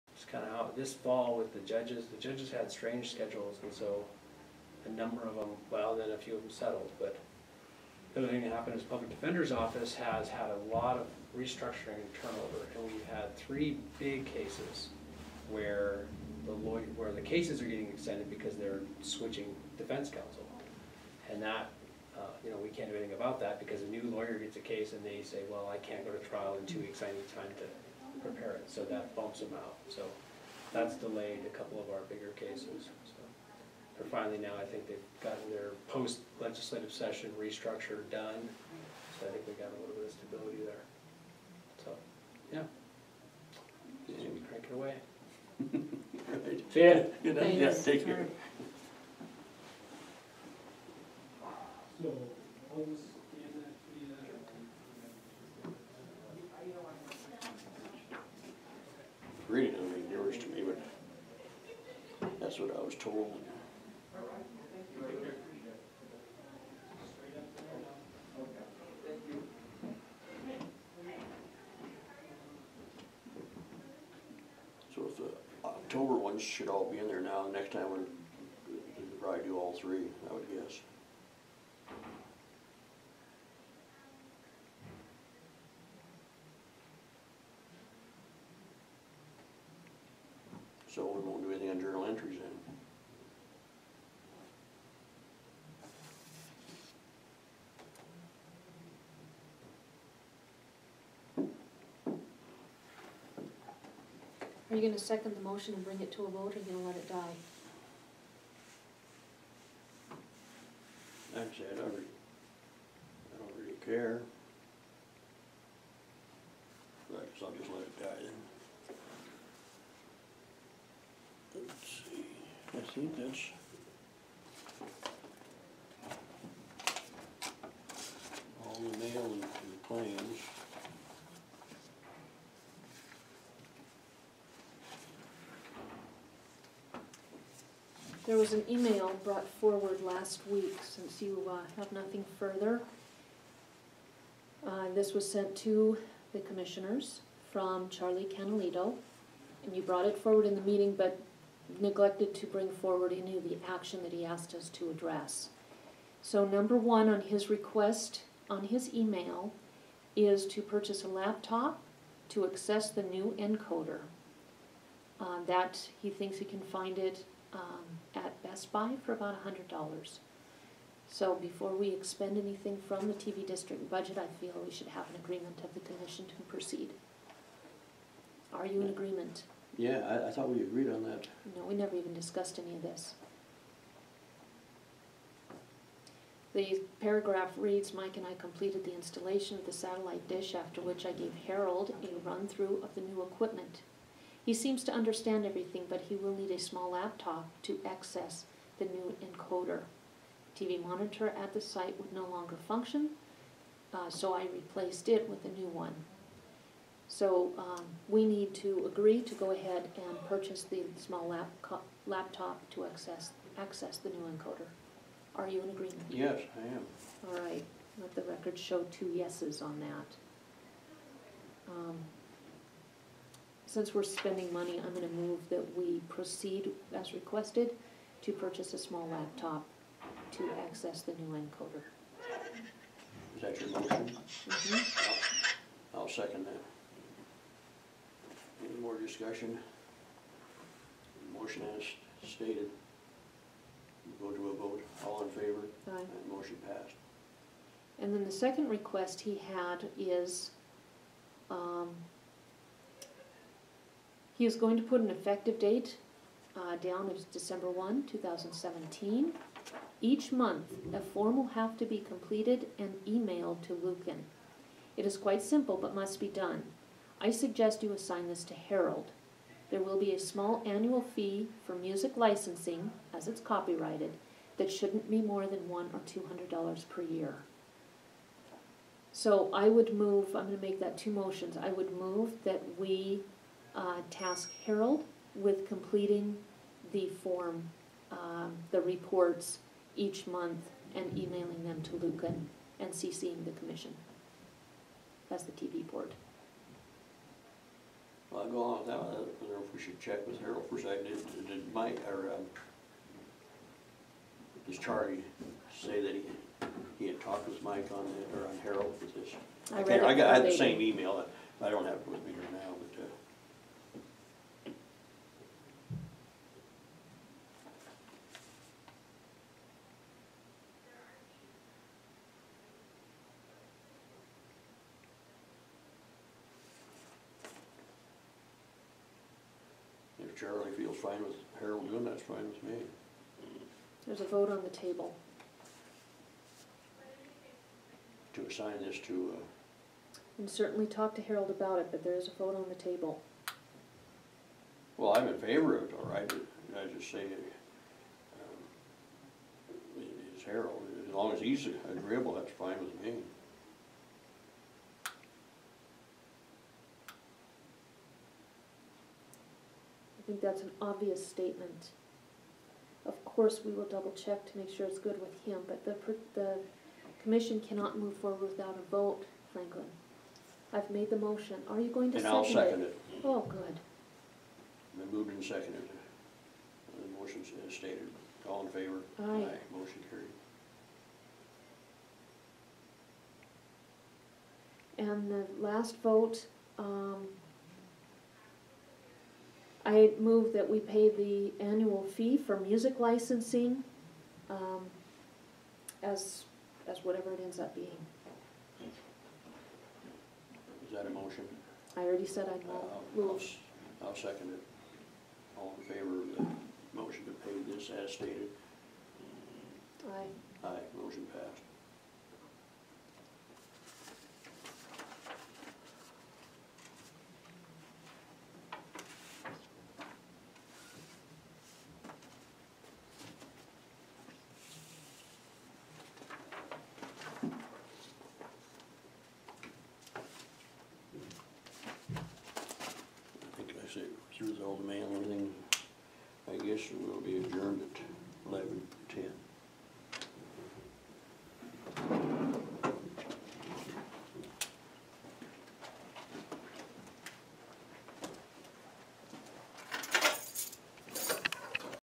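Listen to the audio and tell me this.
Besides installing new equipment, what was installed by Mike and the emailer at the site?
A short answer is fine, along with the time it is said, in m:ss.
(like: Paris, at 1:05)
satellite dish, at 3:09.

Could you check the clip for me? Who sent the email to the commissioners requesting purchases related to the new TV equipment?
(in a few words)
Charlie Canalito.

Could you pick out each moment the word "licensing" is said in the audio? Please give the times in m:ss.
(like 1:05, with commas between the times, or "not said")
4:32, 6:33.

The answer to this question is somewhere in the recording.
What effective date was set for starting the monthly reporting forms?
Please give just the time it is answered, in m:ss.
4:17.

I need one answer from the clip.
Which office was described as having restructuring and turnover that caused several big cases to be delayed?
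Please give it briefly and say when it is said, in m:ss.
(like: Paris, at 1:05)
Public Defender's Office, at 0:08.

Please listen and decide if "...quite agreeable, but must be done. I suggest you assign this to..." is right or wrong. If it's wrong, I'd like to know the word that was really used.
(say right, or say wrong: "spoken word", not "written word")
wrong: "simple", not "agreeable".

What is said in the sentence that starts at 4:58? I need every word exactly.
I don't know if we should check with Harold first.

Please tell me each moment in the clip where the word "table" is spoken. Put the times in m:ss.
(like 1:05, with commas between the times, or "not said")
5:34, 5:42.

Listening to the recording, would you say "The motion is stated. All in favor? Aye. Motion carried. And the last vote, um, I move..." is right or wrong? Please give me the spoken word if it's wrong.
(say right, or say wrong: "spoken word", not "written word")
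right.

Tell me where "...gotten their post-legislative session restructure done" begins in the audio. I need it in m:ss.
0:35.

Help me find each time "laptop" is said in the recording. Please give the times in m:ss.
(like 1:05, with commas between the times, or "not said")
2:41, 3:16, 3:32, 3:49.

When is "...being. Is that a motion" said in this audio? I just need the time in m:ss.
6:37.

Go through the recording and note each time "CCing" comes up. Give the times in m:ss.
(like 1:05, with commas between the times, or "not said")
4:52.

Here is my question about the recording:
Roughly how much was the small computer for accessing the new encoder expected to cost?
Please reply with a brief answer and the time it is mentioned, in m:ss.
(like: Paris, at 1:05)
$100, at 2:49.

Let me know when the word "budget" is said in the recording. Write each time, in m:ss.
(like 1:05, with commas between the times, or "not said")
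2:53.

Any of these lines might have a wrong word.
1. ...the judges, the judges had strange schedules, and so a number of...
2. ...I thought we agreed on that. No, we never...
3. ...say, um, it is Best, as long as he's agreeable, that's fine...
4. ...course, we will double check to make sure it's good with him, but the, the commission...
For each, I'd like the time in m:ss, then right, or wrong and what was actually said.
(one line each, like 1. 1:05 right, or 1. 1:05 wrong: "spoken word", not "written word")
1. 0:01 right
2. 3:00 right
3. 5:47 wrong: "Harold", not "Best"
4. 6:03 right.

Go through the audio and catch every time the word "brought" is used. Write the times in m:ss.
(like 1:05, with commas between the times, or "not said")
2:19, 2:29.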